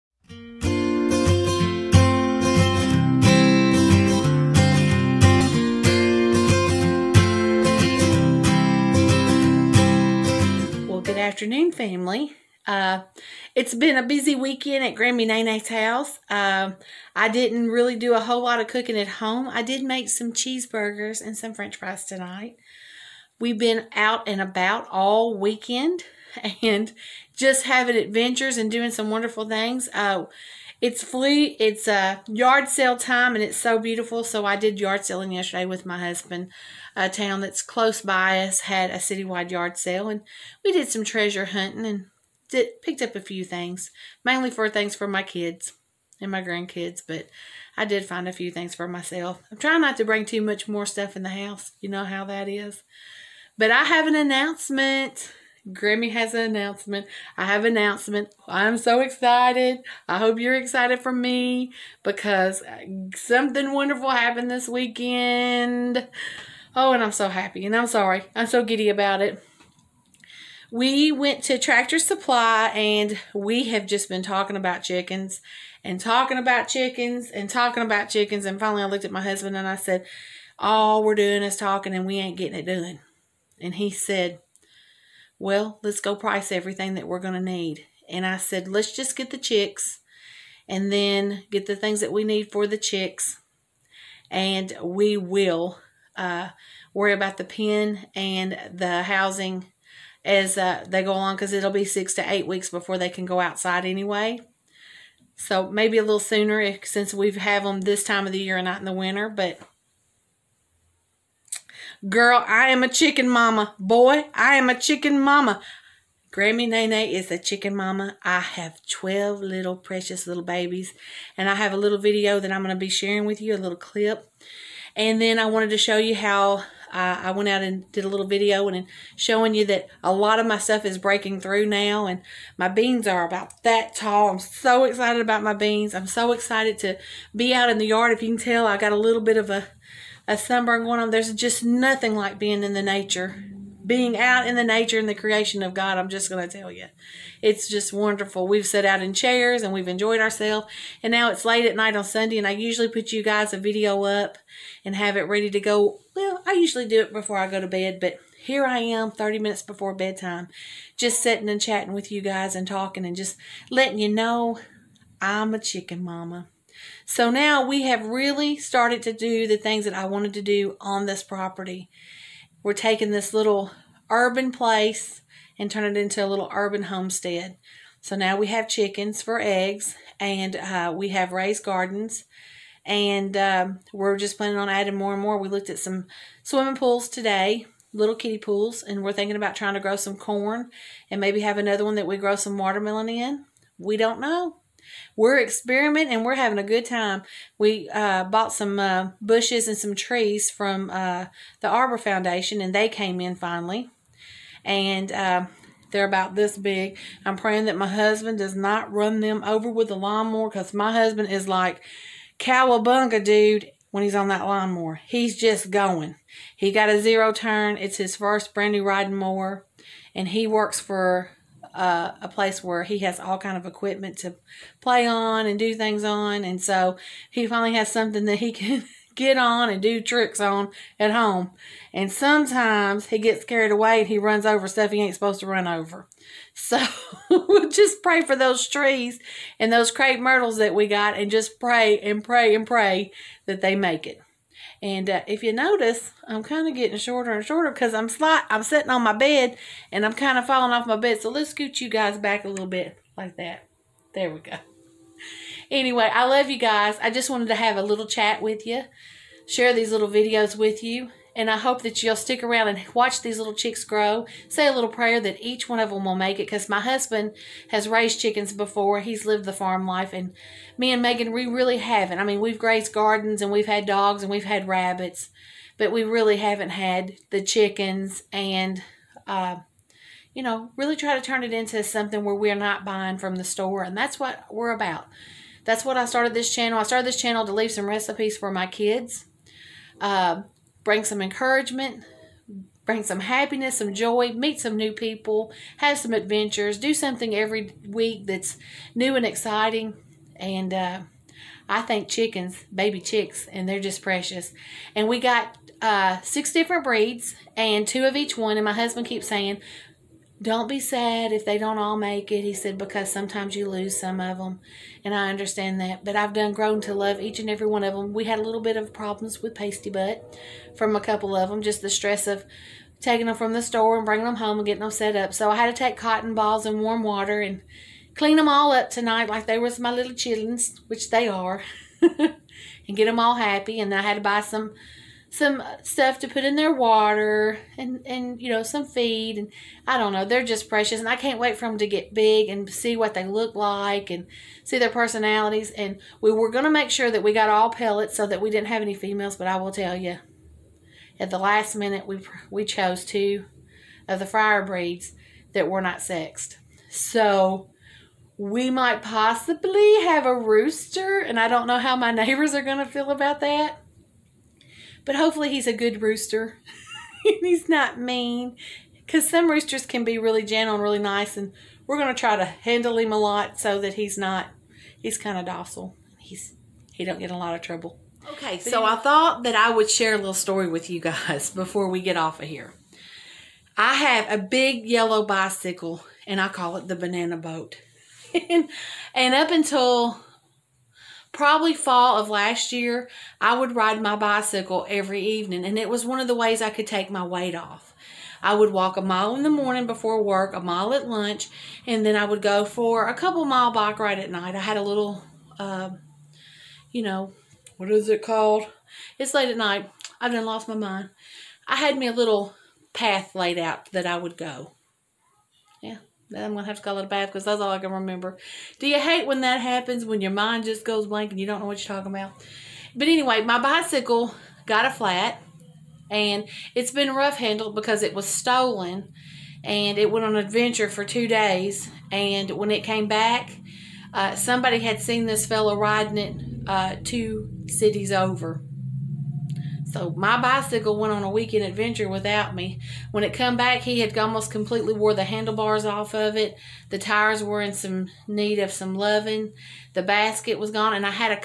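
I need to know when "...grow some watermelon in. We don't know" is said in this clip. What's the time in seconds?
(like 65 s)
192 s.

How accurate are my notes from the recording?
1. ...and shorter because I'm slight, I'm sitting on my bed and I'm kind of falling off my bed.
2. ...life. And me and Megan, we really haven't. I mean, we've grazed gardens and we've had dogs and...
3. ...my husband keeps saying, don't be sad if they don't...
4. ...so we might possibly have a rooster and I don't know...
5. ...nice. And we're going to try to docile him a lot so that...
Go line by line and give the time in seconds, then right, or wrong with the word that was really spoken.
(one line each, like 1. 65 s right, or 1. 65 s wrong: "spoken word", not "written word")
1. 247 s right
2. 269 s right
3. 308 s right
4. 356 s right
5. 370 s wrong: "handle", not "docile".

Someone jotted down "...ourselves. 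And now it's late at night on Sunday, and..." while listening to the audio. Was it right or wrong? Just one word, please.
right.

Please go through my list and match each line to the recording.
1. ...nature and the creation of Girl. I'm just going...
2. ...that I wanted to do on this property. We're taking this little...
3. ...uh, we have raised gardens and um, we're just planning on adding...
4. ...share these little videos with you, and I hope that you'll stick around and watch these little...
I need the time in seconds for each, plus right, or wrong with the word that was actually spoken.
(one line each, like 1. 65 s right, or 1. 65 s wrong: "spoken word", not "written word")
1. 144 s wrong: "God", not "Girl"
2. 169 s right
3. 180 s right
4. 259 s right.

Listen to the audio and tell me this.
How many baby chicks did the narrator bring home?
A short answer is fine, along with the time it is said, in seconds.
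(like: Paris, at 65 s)
12, at 118 s.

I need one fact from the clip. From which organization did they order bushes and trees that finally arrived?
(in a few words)
Arbor Foundation.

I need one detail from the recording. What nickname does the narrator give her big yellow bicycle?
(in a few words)
banana boat.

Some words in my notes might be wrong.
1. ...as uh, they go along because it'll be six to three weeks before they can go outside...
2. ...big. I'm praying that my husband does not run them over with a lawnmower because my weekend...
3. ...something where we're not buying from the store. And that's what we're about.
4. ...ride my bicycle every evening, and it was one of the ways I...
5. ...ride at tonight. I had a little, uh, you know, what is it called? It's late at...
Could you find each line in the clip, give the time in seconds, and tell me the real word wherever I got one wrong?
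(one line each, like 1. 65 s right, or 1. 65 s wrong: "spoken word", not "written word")
1. 100 s wrong: "eight", not "three"
2. 206 s wrong: "husband", not "weekend"
3. 281 s right
4. 393 s right
5. 403 s wrong: "night", not "tonight".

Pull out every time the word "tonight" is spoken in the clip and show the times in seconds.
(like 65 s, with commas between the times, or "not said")
22 s, 328 s.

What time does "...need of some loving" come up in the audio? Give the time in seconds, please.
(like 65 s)
448 s.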